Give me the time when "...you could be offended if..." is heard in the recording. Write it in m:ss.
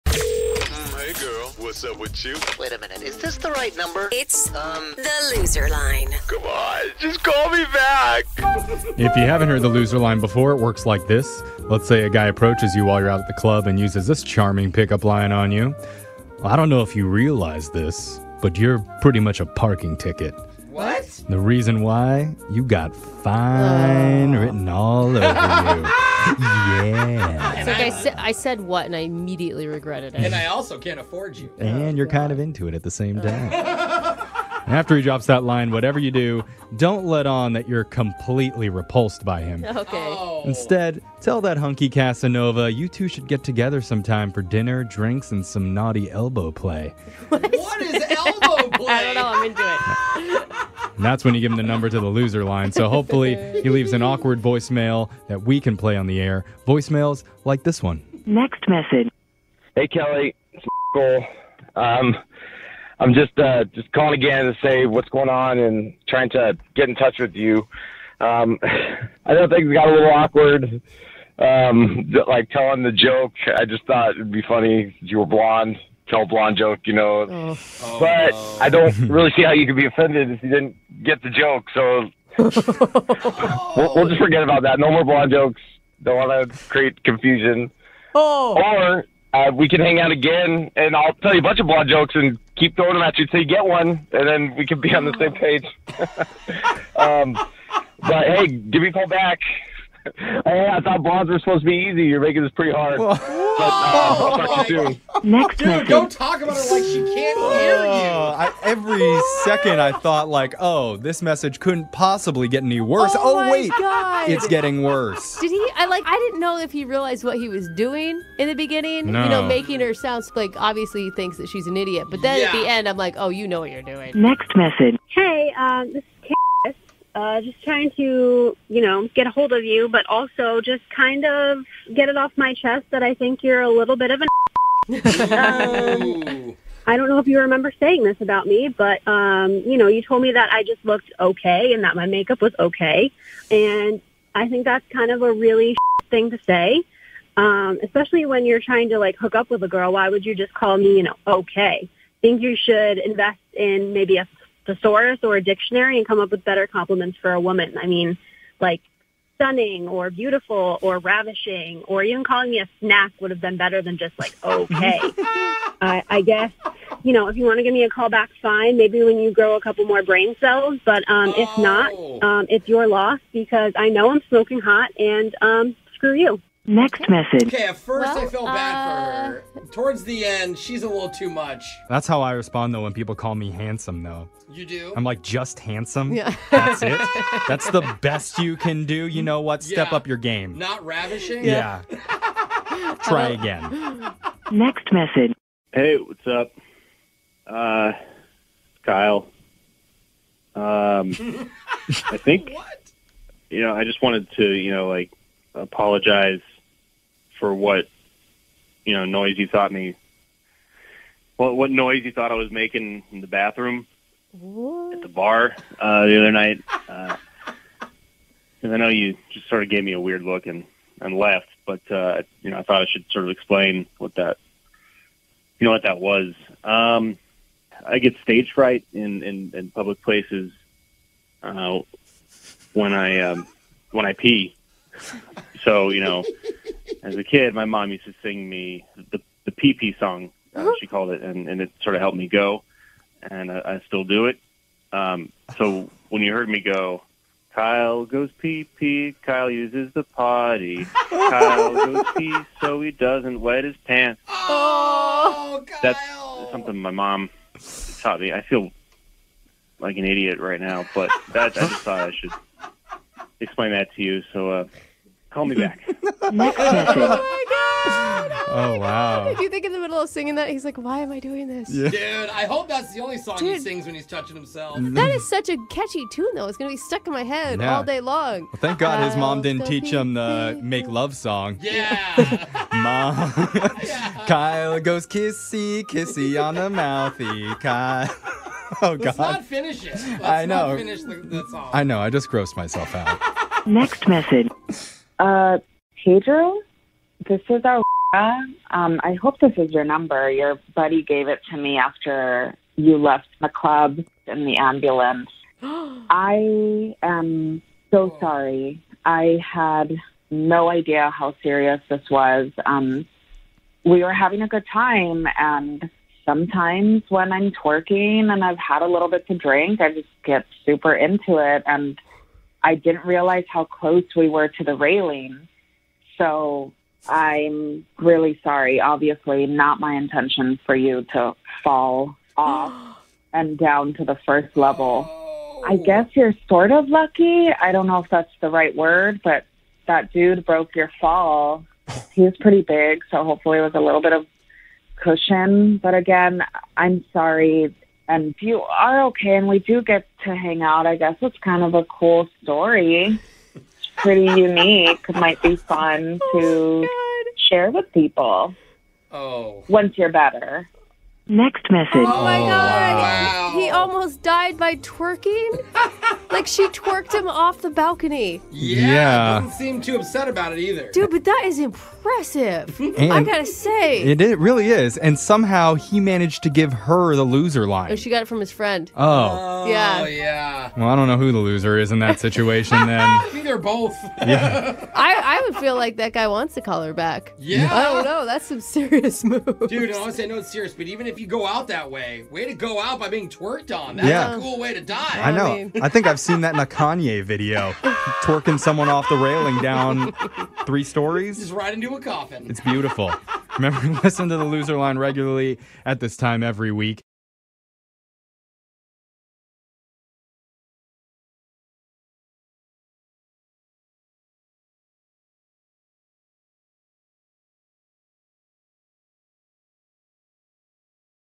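1:19.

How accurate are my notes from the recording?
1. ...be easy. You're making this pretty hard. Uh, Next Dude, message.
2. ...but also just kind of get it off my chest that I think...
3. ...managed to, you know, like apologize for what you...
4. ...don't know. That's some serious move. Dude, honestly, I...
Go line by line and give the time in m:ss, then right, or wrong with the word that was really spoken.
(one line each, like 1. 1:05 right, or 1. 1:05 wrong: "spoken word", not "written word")
1. 1:41 right
2. 2:09 right
3. 3:24 wrong: "wanted", not "managed"
4. 6:27 right.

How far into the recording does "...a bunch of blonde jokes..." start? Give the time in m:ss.
1:31.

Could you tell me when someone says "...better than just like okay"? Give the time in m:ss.
2:43.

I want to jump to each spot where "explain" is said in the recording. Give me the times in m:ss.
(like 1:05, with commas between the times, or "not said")
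3:43, 4:23.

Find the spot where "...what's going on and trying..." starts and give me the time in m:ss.
1:04.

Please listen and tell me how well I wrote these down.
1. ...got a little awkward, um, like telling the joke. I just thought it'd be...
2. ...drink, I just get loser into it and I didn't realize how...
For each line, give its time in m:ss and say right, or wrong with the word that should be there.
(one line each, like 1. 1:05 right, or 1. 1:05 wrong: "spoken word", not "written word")
1. 1:09 right
2. 5:19 wrong: "super", not "loser".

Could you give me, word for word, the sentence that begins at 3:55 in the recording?
So you know, as a kid, my mom used to sing me the the pee pee song.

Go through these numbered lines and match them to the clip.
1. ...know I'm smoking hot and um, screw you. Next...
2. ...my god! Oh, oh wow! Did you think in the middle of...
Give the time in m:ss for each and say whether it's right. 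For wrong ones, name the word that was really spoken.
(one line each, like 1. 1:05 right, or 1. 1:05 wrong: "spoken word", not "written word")
1. 2:53 right
2. 4:26 right.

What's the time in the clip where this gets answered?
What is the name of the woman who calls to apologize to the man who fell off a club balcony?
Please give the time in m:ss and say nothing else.
4:57.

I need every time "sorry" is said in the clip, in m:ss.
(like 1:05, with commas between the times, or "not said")
5:08, 5:28, 5:47.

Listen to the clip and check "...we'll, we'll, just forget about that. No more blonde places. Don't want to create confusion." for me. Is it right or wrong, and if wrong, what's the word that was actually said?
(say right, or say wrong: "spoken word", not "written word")
wrong: "jokes", not "places".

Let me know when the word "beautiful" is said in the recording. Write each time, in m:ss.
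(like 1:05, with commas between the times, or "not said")
2:40, 6:42.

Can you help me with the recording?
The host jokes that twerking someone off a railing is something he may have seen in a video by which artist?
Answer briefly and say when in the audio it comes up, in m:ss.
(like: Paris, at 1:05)
Kanye, at 6:36.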